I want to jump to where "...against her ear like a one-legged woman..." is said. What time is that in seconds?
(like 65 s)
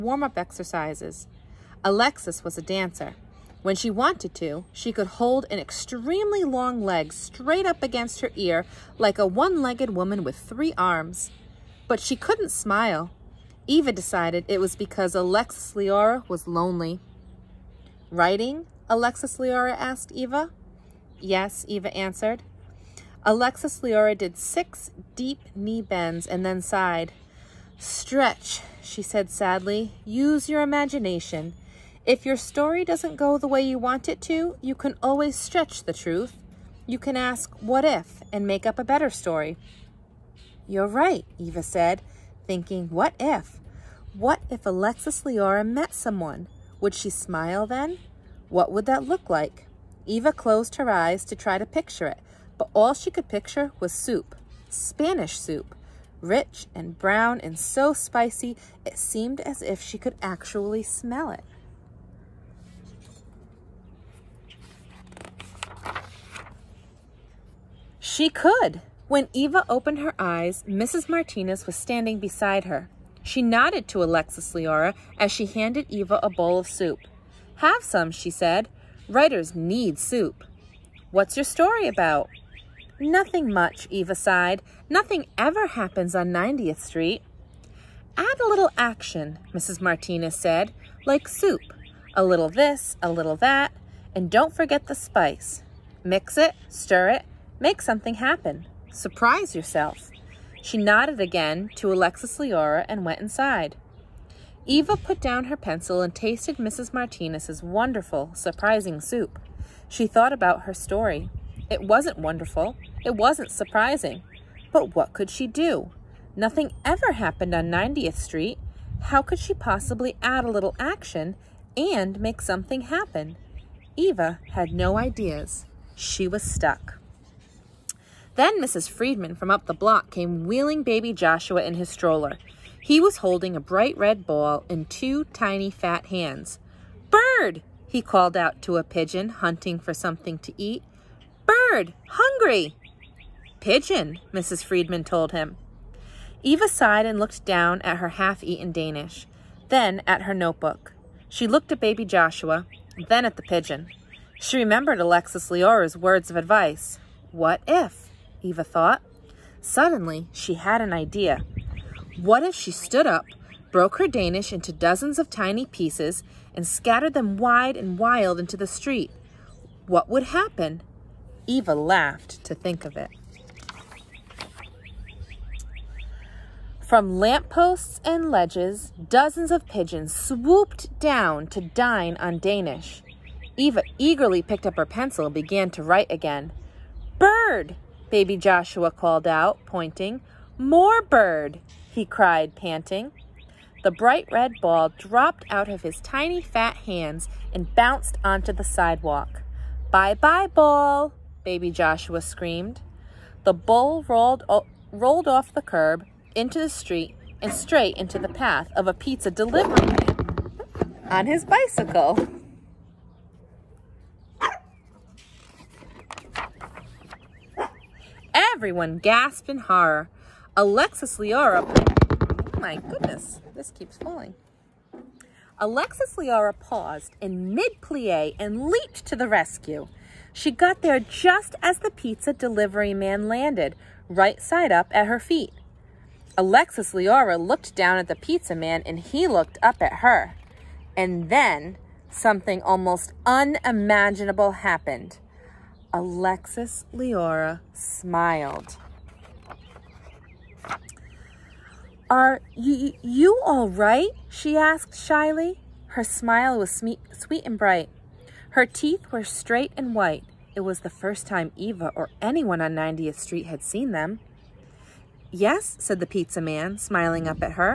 7 s.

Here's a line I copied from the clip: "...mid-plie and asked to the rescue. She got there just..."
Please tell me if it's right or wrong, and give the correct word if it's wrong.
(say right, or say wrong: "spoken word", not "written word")
wrong: "leaped", not "asked".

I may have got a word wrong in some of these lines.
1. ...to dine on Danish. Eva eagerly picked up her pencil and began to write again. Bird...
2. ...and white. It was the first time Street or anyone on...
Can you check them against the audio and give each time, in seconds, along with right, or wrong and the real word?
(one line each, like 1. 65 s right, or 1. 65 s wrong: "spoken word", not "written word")
1. 181 s right
2. 259 s wrong: "Eva", not "Street".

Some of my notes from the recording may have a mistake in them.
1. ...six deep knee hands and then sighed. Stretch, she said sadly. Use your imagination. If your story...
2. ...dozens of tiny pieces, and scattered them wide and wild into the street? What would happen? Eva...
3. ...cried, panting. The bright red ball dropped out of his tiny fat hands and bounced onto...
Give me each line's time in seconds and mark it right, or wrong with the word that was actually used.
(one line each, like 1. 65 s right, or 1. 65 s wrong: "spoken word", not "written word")
1. 24 s wrong: "bends", not "hands"
2. 164 s right
3. 192 s right.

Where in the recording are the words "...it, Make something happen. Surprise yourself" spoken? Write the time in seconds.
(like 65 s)
97 s.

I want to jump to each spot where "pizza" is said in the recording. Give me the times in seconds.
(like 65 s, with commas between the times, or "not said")
208 s, 231 s, 238 s, 266 s.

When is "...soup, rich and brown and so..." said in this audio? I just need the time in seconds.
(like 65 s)
55 s.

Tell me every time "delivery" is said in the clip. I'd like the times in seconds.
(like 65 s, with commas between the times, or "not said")
209 s, 232 s.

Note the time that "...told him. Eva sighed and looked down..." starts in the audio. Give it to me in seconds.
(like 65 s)
145 s.